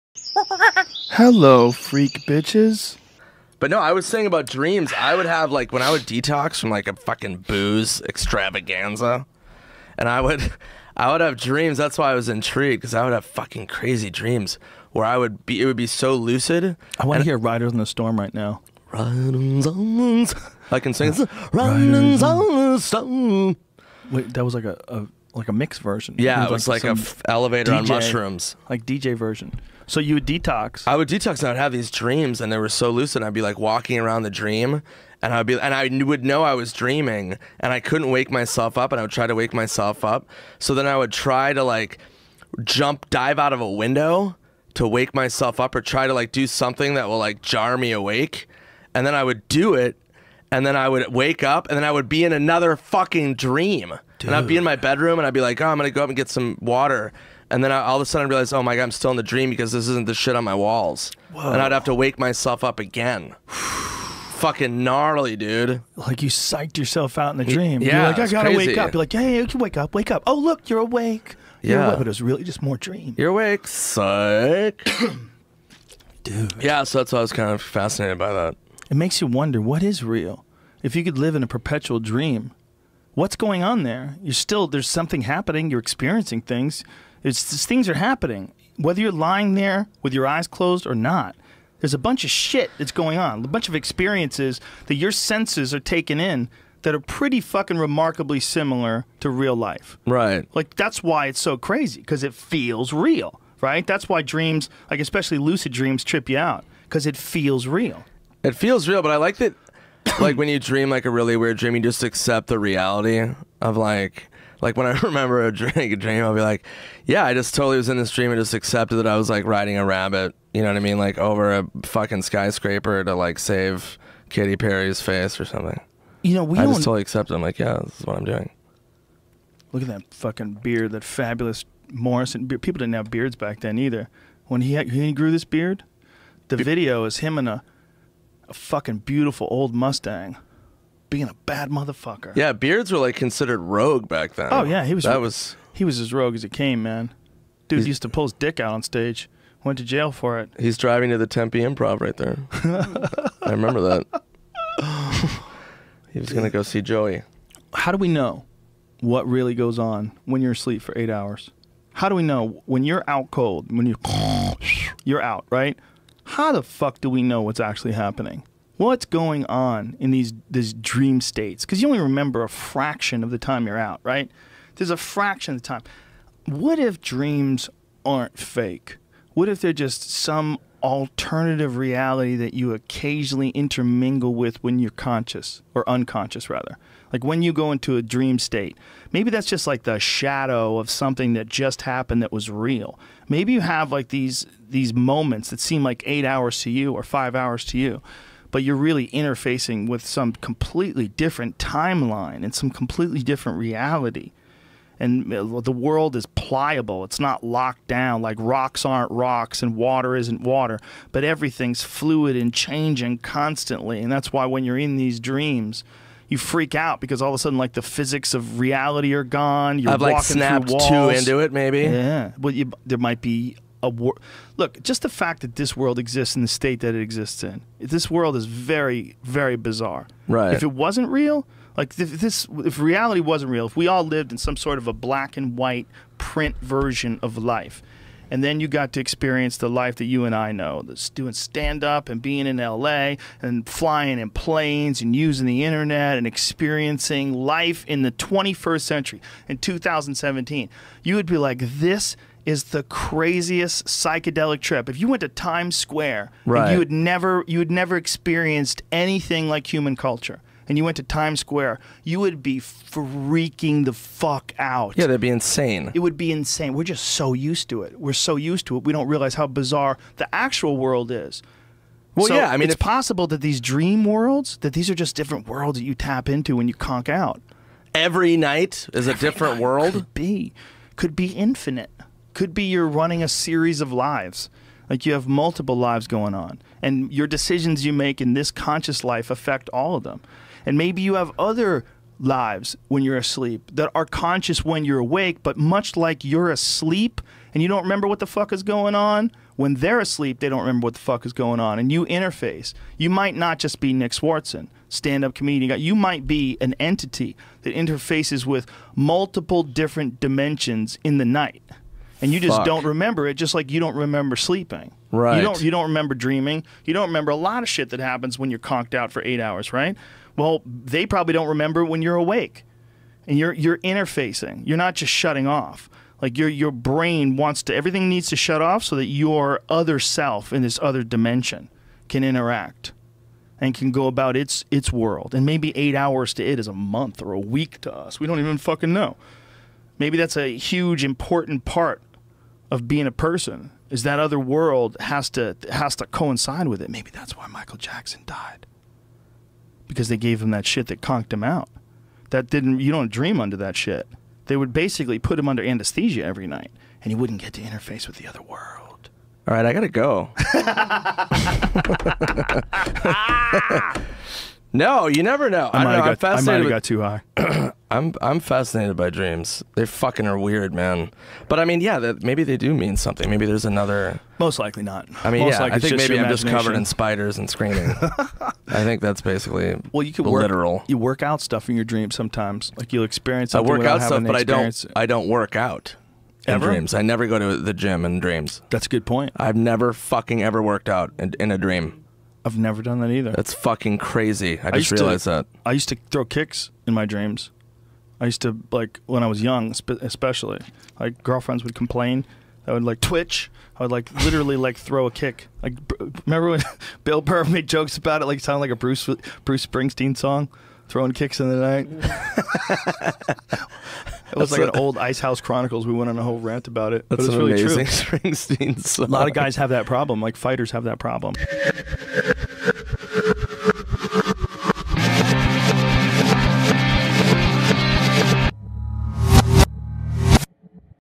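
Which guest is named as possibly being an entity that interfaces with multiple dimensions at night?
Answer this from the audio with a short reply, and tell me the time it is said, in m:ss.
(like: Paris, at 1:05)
Nick Swardson, at 5:03.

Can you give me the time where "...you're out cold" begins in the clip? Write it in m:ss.
2:42.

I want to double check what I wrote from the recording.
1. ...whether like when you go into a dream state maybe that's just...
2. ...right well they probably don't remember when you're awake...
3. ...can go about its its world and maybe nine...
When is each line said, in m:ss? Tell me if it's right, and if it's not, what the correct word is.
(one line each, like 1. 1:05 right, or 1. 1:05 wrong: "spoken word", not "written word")
1. 3:06 wrong: "rather", not "whether"
2. 5:19 right
3. 5:33 wrong: "eight", not "nine".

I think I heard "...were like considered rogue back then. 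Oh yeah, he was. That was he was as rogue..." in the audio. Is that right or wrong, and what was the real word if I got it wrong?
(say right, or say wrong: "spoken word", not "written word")
right.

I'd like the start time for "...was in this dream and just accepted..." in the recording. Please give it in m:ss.
1:57.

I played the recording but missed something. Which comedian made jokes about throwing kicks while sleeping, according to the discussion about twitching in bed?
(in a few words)
Bill Burr.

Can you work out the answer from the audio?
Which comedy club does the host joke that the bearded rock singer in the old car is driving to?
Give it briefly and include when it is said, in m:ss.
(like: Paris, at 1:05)
Tempe Improv, at 2:31.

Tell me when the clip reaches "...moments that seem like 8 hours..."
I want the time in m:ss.
3:14.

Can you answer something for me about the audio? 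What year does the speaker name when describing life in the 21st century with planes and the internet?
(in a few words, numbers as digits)
2017.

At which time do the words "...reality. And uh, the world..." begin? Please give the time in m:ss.
3:23.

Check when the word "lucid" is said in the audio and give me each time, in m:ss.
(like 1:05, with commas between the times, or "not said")
0:16, 0:32, 1:45.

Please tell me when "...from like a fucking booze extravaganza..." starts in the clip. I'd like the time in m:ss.
0:06.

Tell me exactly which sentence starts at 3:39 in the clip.
You're I've walking like snapped through walls.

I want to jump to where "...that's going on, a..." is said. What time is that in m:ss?
1:32.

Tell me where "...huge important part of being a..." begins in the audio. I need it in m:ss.
5:40.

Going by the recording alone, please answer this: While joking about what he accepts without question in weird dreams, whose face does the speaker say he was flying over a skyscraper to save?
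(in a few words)
Katy Perry.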